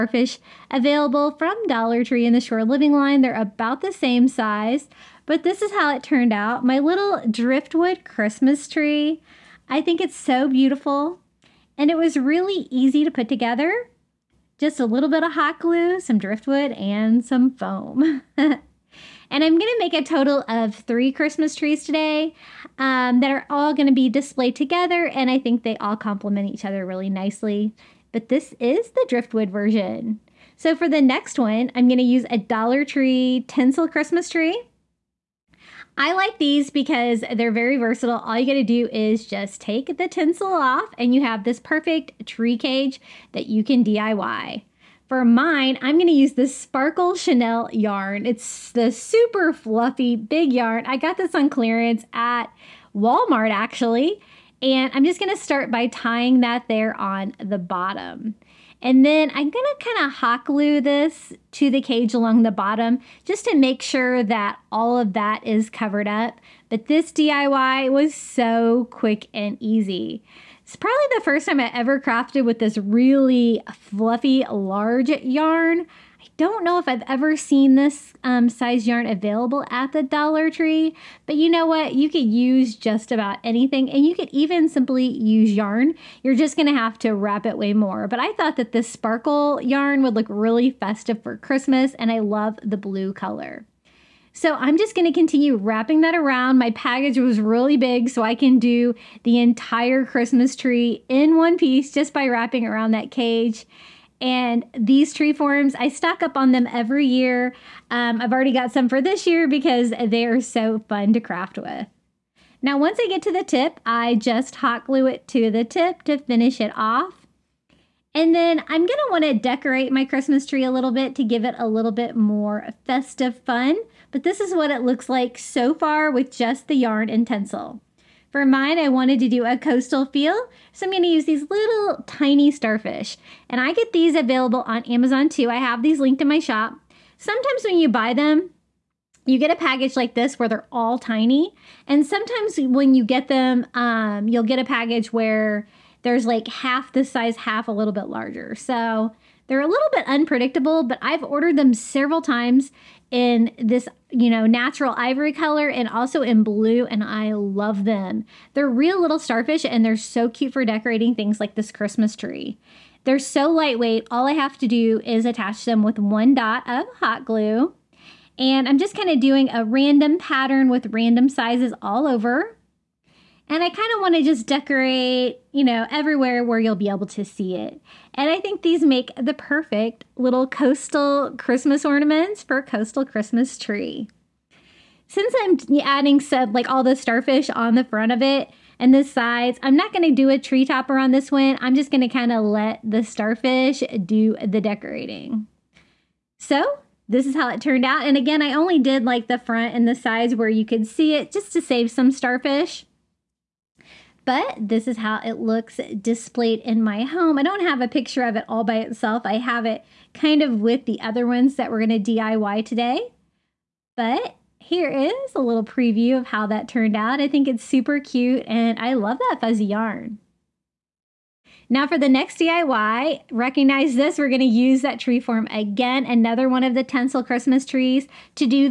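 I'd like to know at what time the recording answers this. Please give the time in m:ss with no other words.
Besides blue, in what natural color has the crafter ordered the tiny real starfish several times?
2:34.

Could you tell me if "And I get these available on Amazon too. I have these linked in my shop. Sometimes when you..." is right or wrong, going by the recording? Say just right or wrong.
right.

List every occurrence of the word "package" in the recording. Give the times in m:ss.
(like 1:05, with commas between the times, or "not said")
1:36, 2:19, 2:24.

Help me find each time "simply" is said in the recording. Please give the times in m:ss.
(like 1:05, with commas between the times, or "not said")
1:24.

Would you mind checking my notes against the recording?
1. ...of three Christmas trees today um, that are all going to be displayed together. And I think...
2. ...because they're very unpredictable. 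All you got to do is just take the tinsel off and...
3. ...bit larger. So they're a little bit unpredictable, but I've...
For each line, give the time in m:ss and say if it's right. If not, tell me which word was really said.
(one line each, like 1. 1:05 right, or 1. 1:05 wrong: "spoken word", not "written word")
1. 0:20 right
2. 0:36 wrong: "versatile", not "unpredictable"
3. 2:27 right.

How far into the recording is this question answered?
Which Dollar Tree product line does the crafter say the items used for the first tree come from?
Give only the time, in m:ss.
0:02.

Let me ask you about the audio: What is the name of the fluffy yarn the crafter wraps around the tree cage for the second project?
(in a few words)
Sparkle Chenille.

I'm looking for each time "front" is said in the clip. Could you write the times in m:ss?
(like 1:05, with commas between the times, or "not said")
3:07, 3:19.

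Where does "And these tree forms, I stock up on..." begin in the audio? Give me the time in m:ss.
1:44.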